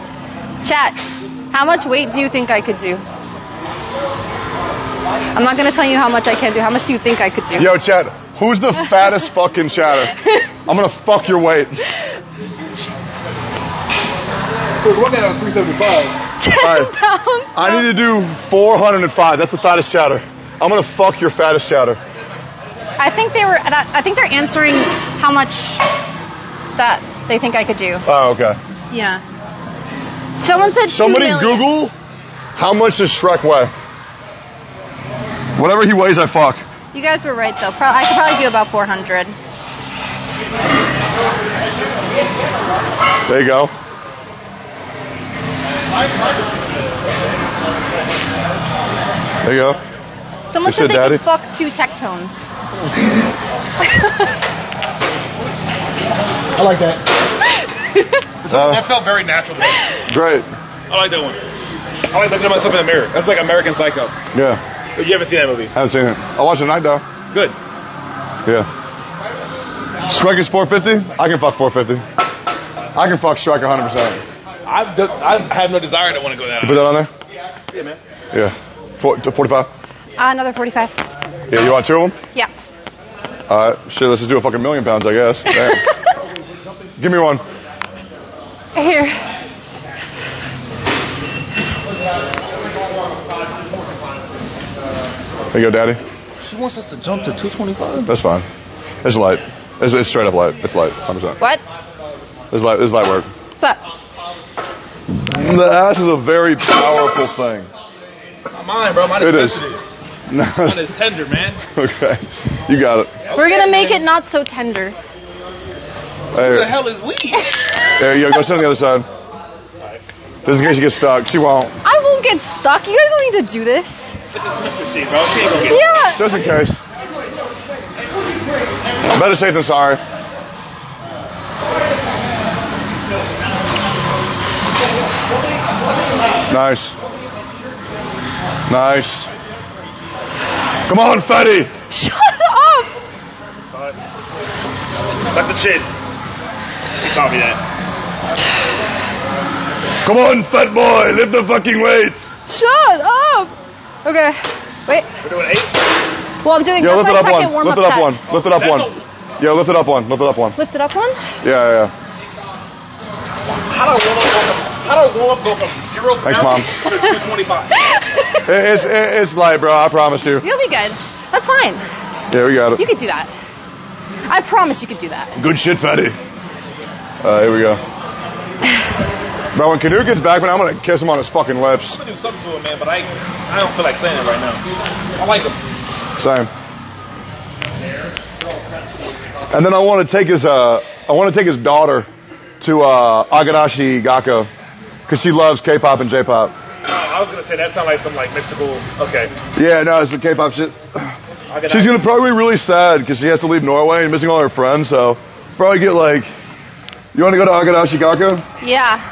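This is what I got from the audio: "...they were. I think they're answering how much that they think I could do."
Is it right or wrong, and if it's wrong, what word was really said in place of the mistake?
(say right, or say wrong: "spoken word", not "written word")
right.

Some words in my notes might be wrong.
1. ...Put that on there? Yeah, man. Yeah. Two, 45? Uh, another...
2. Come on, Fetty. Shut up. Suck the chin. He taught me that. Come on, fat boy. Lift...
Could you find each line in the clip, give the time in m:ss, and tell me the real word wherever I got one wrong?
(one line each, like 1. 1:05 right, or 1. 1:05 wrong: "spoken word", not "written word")
1. 1:16 wrong: "Four", not "Two"
2. 2:20 right.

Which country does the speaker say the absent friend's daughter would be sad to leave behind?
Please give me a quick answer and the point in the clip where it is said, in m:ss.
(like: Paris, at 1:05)
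Norway, at 3:23.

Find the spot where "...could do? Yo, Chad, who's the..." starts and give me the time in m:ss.
0:07.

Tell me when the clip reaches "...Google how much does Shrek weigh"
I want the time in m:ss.
0:31.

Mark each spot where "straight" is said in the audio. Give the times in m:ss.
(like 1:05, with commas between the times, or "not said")
1:40.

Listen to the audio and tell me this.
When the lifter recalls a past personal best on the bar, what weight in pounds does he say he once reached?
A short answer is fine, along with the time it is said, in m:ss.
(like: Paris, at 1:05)
375, at 0:15.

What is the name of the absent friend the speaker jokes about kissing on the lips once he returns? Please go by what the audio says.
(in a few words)
Knut.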